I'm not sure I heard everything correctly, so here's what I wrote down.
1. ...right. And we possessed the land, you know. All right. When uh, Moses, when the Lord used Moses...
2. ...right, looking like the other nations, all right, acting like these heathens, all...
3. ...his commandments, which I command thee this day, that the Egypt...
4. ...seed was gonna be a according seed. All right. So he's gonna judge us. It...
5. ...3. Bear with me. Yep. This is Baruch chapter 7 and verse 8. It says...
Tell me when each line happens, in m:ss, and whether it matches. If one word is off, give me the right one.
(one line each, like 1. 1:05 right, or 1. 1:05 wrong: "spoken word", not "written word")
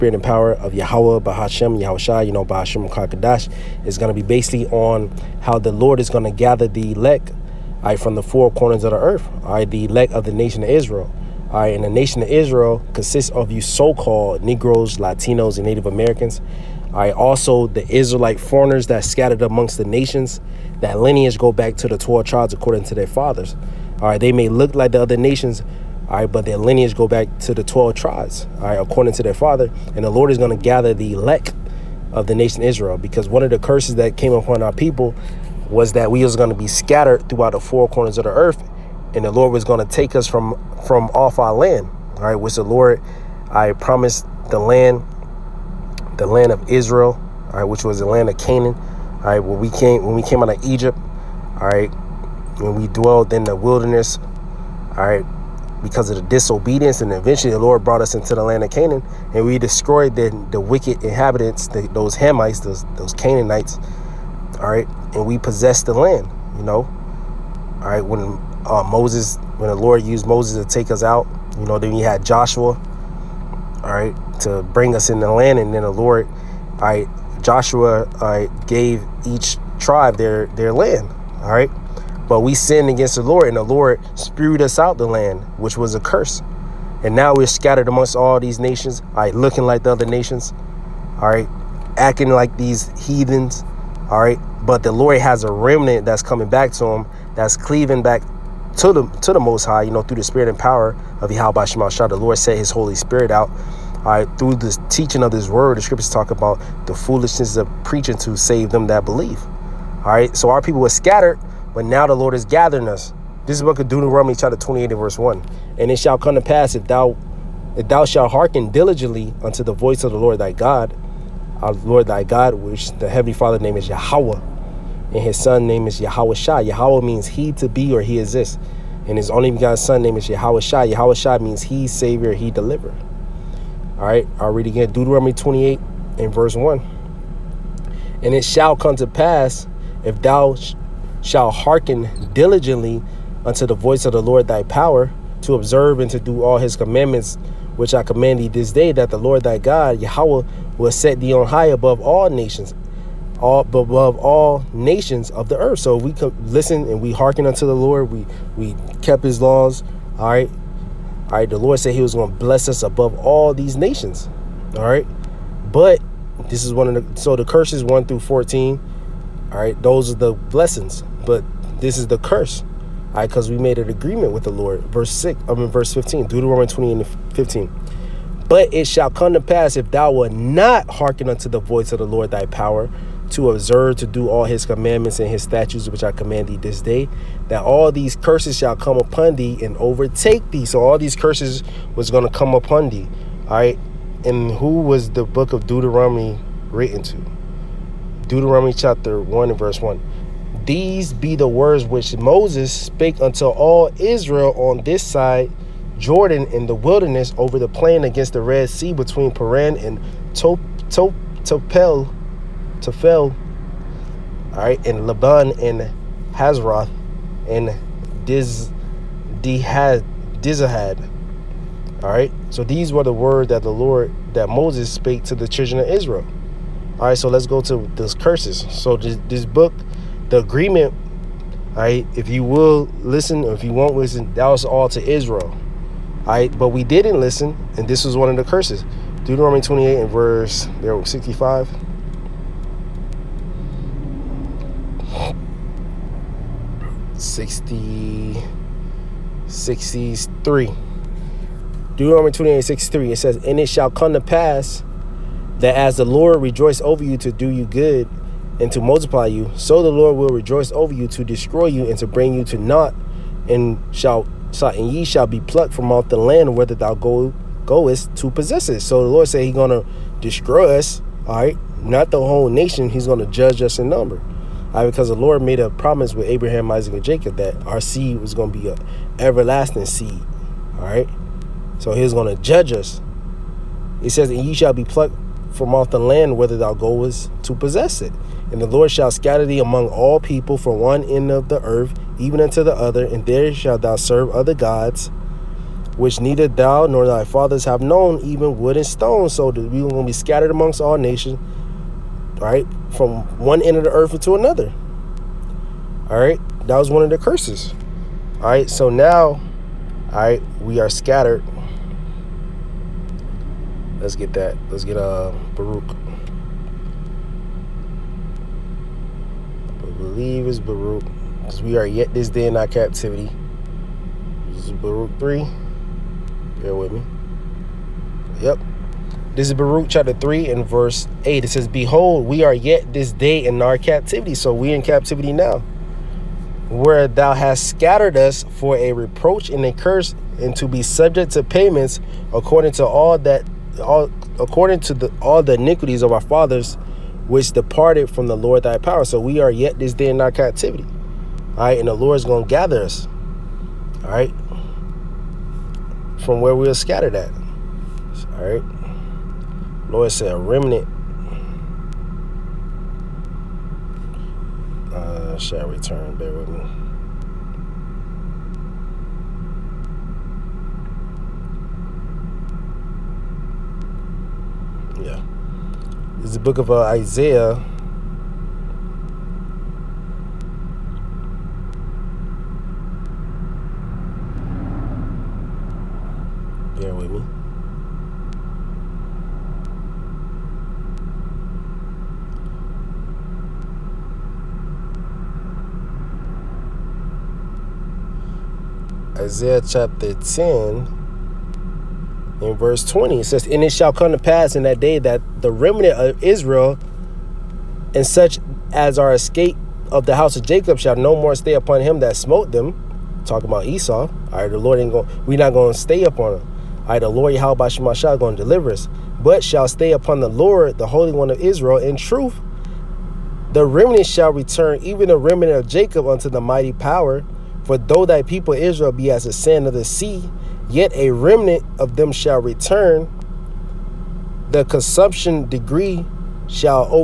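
1. 1:04 right
2. 1:29 right
3. 2:26 wrong: "Lord", not "Egypt"
4. 4:37 wrong: "everlasting", not "according"
5. 5:25 wrong: "3", not "7".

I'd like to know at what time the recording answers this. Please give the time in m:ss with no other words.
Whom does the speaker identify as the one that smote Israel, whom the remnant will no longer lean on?
6:53.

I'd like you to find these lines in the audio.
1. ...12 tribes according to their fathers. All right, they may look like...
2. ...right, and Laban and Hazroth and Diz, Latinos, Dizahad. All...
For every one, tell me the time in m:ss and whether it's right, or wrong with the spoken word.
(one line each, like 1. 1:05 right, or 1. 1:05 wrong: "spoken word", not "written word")
1. 0:21 right
2. 3:34 wrong: "Dihad", not "Latinos".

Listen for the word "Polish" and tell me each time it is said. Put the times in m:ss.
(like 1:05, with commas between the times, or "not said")
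not said.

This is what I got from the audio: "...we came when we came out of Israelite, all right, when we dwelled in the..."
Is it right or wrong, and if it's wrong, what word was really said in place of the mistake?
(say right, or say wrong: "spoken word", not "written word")
wrong: "Egypt", not "Israelite".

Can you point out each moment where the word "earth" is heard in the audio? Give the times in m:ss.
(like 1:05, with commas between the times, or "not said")
0:08, 0:38, 2:35, 4:51, 5:03.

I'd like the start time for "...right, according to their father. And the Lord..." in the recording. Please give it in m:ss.
0:28.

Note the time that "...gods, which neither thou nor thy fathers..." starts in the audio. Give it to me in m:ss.
4:54.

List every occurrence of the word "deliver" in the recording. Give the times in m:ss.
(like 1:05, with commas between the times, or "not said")
2:12, 6:58.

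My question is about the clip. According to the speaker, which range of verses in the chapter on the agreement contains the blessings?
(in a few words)
1 through 14.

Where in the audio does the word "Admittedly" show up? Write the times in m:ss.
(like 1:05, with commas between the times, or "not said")
not said.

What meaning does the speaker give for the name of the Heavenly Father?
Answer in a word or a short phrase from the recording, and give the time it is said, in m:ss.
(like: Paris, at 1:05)
He exists, at 2:08.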